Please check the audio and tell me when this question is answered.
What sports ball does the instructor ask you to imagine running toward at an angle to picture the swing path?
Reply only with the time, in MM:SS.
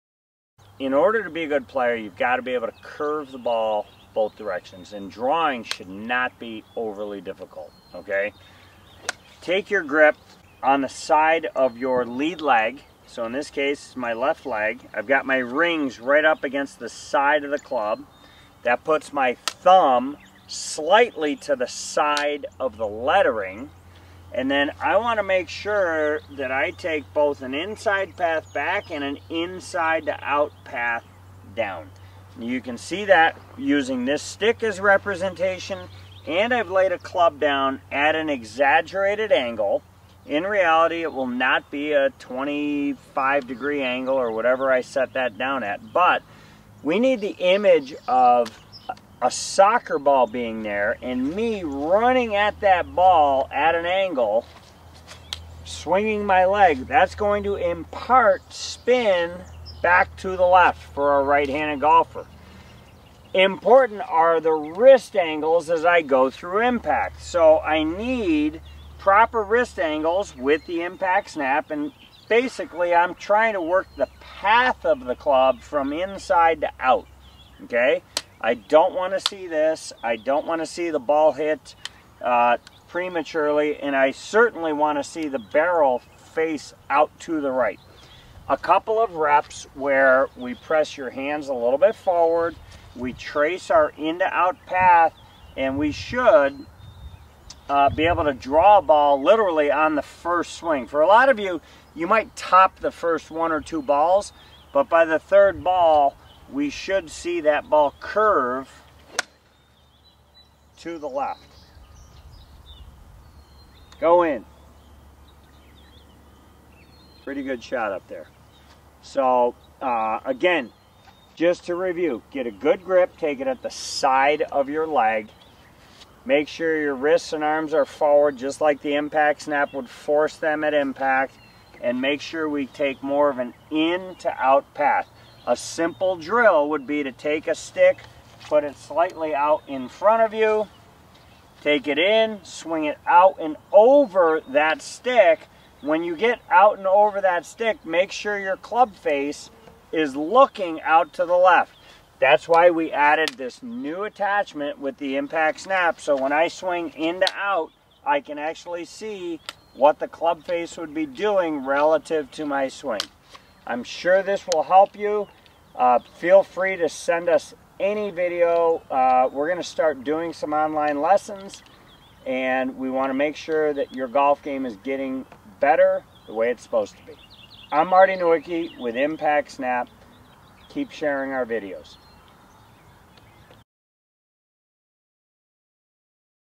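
00:49.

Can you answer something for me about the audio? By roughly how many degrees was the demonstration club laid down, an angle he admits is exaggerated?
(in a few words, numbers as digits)
25.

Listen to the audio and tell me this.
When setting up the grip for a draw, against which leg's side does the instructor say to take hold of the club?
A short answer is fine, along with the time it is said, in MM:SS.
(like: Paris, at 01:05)
lead leg, at 00:12.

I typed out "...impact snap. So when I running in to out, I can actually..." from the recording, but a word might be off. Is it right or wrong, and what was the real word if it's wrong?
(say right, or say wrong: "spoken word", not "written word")
wrong: "swing", not "running".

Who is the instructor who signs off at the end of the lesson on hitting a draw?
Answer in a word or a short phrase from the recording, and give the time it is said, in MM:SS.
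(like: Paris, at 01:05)
Marty Nowicki, at 02:57.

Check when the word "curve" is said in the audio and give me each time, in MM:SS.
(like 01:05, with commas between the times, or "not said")
00:02, 01:47.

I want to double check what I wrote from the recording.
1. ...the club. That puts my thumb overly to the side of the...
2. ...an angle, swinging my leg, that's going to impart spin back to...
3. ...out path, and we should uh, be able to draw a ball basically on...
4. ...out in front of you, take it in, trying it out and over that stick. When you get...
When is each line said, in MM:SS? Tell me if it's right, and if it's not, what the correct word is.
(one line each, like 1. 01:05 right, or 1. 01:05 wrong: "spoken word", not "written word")
1. 00:17 wrong: "slightly", not "overly"
2. 00:53 right
3. 01:34 wrong: "literally", not "basically"
4. 02:19 wrong: "swing", not "trying".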